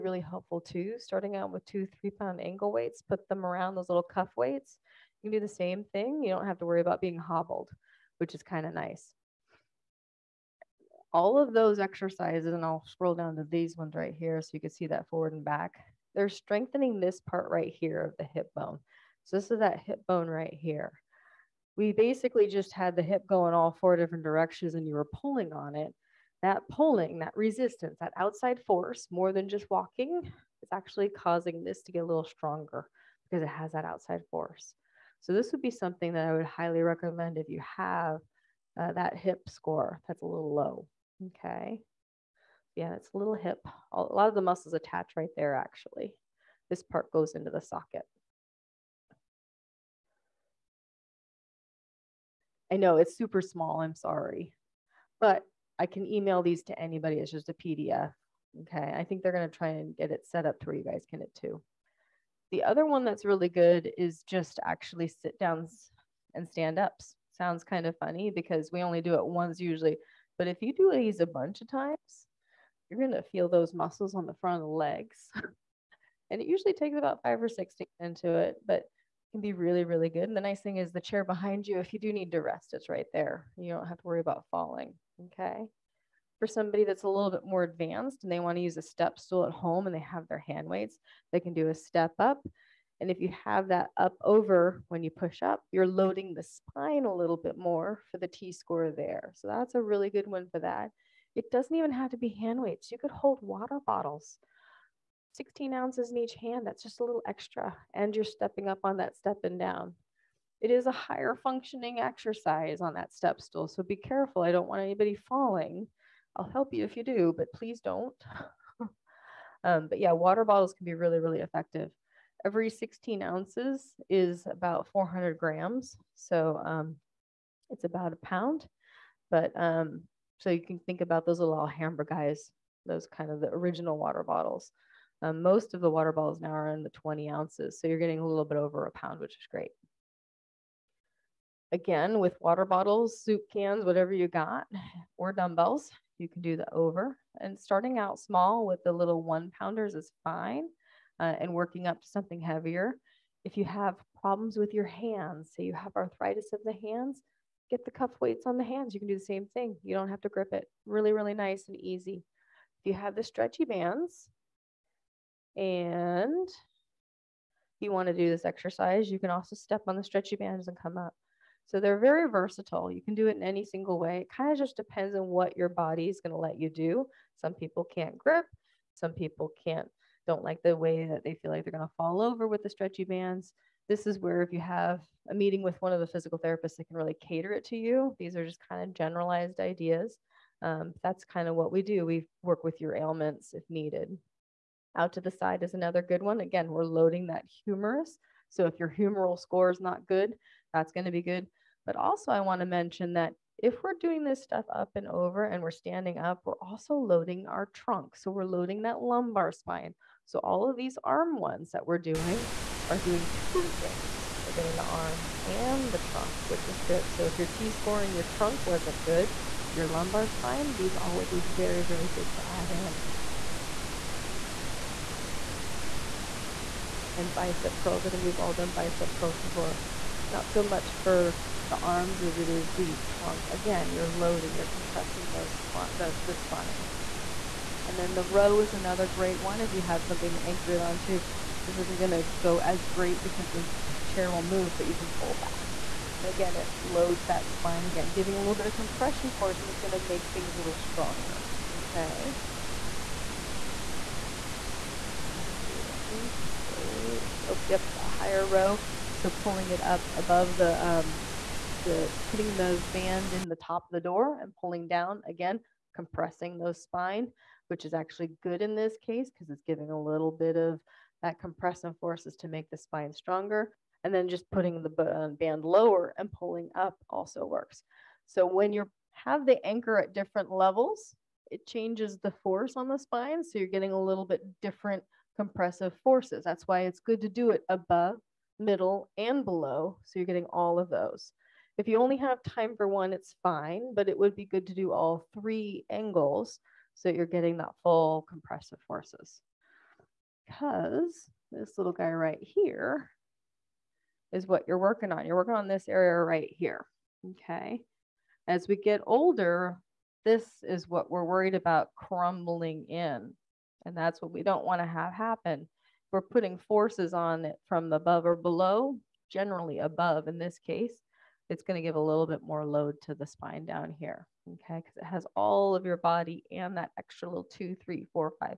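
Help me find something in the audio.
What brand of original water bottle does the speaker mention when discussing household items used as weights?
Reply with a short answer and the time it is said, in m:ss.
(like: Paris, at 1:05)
Alhambra, at 2:11.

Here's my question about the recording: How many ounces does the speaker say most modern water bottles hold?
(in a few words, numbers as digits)
20 ounces.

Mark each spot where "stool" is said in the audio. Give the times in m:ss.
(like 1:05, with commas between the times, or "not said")
1:29, 1:53.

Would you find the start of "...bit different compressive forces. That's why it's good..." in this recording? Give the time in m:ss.
4:44.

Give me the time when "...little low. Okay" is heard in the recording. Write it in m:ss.
0:40.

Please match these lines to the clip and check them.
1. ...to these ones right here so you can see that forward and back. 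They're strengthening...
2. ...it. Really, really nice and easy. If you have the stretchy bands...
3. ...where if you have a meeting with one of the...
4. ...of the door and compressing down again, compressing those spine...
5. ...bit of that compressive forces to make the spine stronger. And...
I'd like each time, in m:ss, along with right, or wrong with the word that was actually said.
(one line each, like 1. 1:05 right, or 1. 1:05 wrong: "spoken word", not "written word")
1. 0:13 right
2. 2:40 right
3. 3:04 right
4. 4:23 wrong: "pulling", not "compressing"
5. 4:30 right.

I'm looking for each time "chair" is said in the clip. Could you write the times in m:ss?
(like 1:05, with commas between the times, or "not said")
1:20, 4:04.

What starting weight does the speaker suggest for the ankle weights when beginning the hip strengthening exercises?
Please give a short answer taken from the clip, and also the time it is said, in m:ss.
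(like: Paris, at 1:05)
2 to 3 pounds, at 0:01.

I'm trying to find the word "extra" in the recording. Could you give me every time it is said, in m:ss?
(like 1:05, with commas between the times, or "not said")
1:47, 5:26.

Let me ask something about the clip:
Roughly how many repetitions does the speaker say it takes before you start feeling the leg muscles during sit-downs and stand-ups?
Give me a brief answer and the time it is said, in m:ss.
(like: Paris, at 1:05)
5 or 6, at 1:17.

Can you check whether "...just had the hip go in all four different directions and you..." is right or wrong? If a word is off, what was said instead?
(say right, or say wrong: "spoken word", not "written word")
right.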